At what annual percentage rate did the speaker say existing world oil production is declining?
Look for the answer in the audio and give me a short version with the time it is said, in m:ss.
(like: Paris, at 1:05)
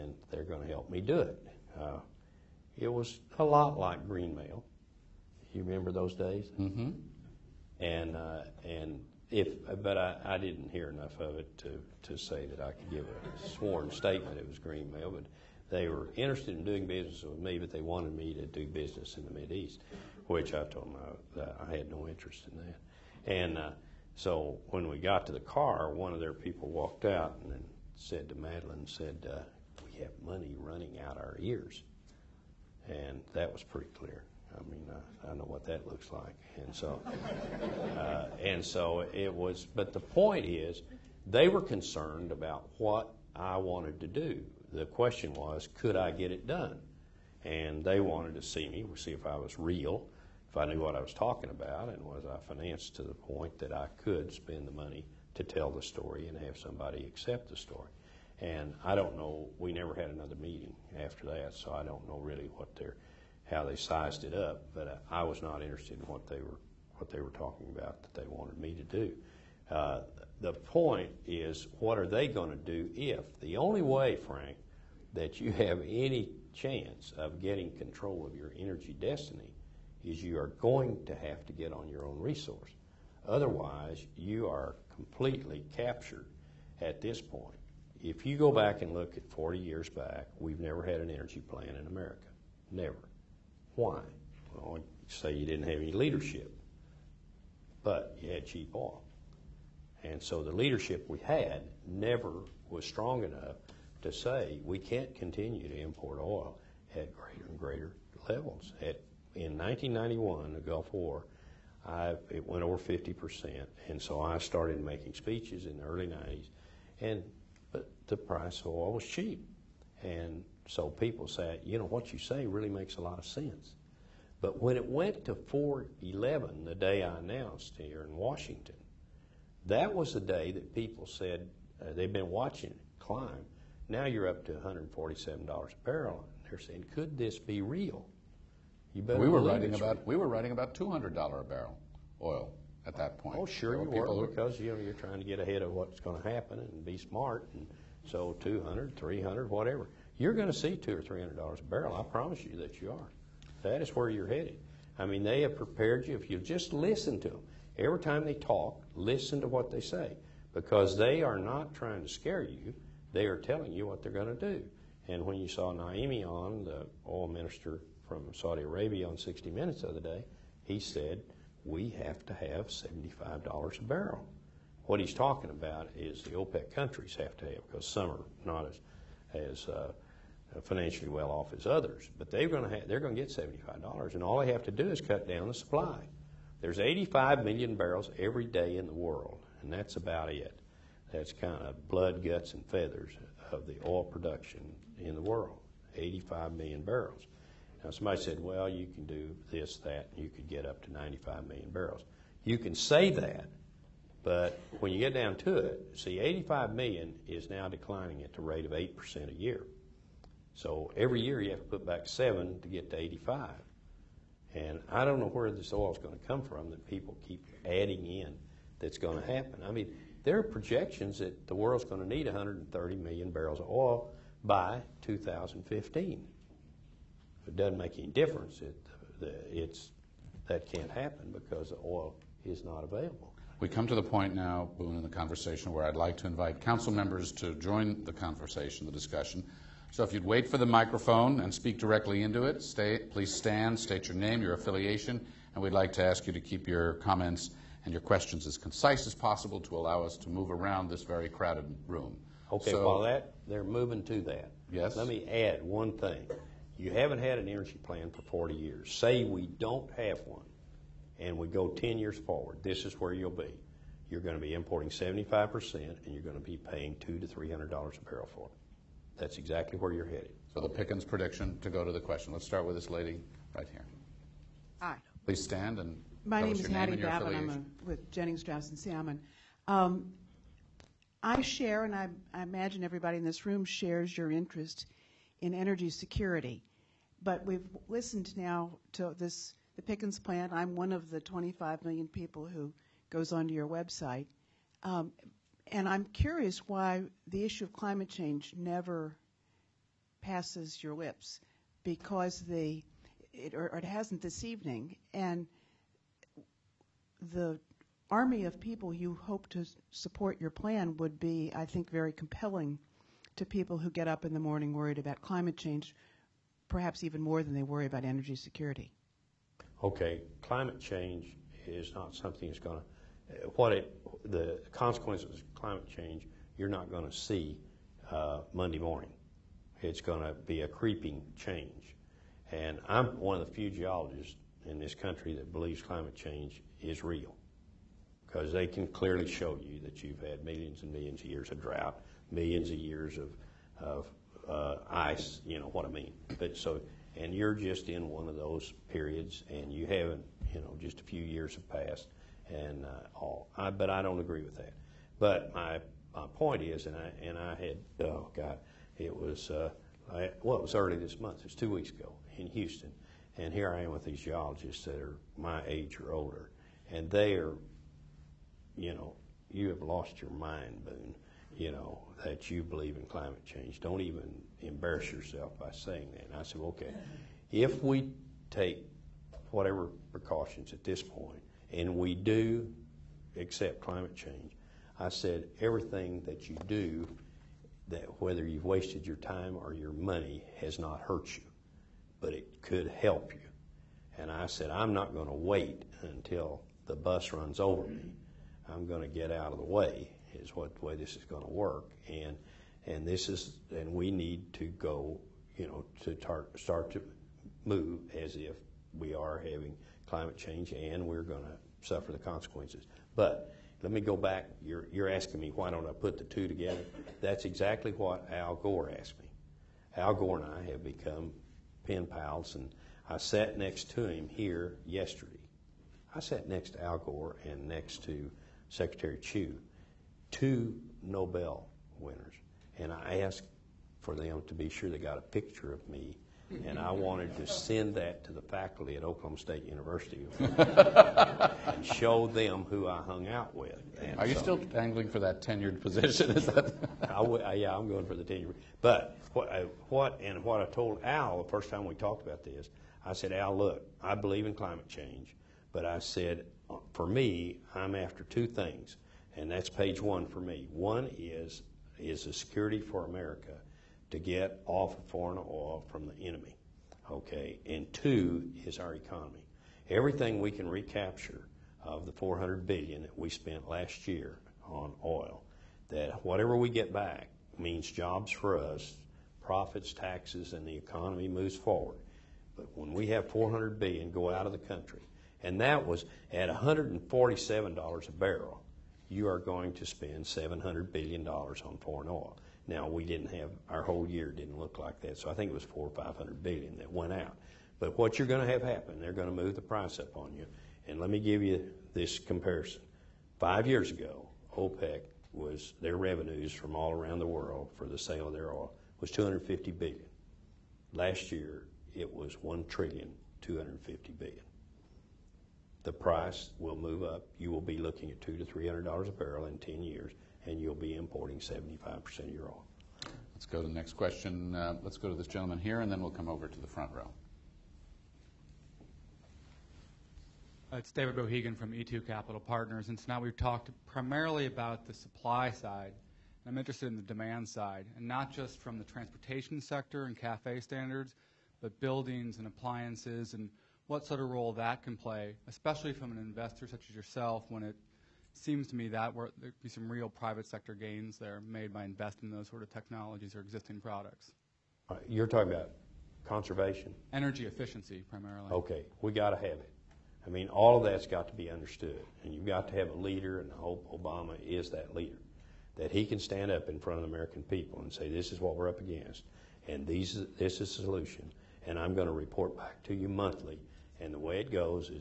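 8%, at 3:28.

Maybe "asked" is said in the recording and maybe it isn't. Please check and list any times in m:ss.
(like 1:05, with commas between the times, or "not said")
6:58, 7:13.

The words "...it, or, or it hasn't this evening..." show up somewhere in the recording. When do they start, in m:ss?
5:03.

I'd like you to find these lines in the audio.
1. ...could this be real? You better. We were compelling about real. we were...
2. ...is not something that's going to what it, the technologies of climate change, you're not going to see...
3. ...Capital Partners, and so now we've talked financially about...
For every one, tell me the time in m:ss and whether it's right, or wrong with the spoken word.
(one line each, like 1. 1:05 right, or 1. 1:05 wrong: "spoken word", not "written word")
1. 2:16 wrong: "writing", not "compelling"
2. 5:21 wrong: "consequences", not "technologies"
3. 8:52 wrong: "primarily", not "financially".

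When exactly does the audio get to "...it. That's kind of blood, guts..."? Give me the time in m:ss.
3:10.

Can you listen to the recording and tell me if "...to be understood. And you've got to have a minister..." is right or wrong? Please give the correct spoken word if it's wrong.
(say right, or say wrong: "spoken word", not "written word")
wrong: "leader", not "minister".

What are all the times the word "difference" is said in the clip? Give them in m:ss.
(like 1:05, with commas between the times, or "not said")
3:48.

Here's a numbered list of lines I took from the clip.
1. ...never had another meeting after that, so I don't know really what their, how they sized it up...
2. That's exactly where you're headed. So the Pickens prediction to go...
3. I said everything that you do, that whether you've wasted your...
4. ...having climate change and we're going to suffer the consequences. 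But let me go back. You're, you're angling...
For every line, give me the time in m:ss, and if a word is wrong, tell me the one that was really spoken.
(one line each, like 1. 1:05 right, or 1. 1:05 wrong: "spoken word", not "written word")
1. 0:59 right
2. 4:29 right
3. 6:24 right
4. 6:49 wrong: "asking", not "angling".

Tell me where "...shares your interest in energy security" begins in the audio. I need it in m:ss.
4:43.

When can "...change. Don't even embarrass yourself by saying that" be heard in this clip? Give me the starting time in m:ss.
6:13.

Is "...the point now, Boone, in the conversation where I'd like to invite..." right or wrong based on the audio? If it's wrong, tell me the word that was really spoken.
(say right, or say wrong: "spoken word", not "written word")
right.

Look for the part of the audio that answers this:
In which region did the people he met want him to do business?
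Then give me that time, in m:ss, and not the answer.
0:19.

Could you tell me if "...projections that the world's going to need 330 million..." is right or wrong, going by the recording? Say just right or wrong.
wrong.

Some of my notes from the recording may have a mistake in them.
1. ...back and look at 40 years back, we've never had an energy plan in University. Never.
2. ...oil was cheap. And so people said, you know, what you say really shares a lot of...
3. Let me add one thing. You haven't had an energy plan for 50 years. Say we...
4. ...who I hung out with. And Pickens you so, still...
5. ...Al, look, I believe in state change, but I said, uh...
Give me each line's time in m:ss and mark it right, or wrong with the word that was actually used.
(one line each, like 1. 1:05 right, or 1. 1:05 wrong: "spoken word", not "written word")
1. 1:28 wrong: "America", not "University"
2. 1:58 wrong: "makes", not "shares"
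3. 4:14 wrong: "40", not "50"
4. 7:22 wrong: "Are", not "Pickens"
5. 7:33 wrong: "climate", not "state".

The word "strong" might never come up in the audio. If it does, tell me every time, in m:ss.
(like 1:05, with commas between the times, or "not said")
1:42.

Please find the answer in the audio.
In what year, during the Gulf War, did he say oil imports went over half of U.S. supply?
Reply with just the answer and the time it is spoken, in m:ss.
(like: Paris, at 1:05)
1991, at 1:49.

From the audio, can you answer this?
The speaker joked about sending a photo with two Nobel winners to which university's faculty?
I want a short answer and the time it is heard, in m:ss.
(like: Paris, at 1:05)
Oklahoma State University, at 7:19.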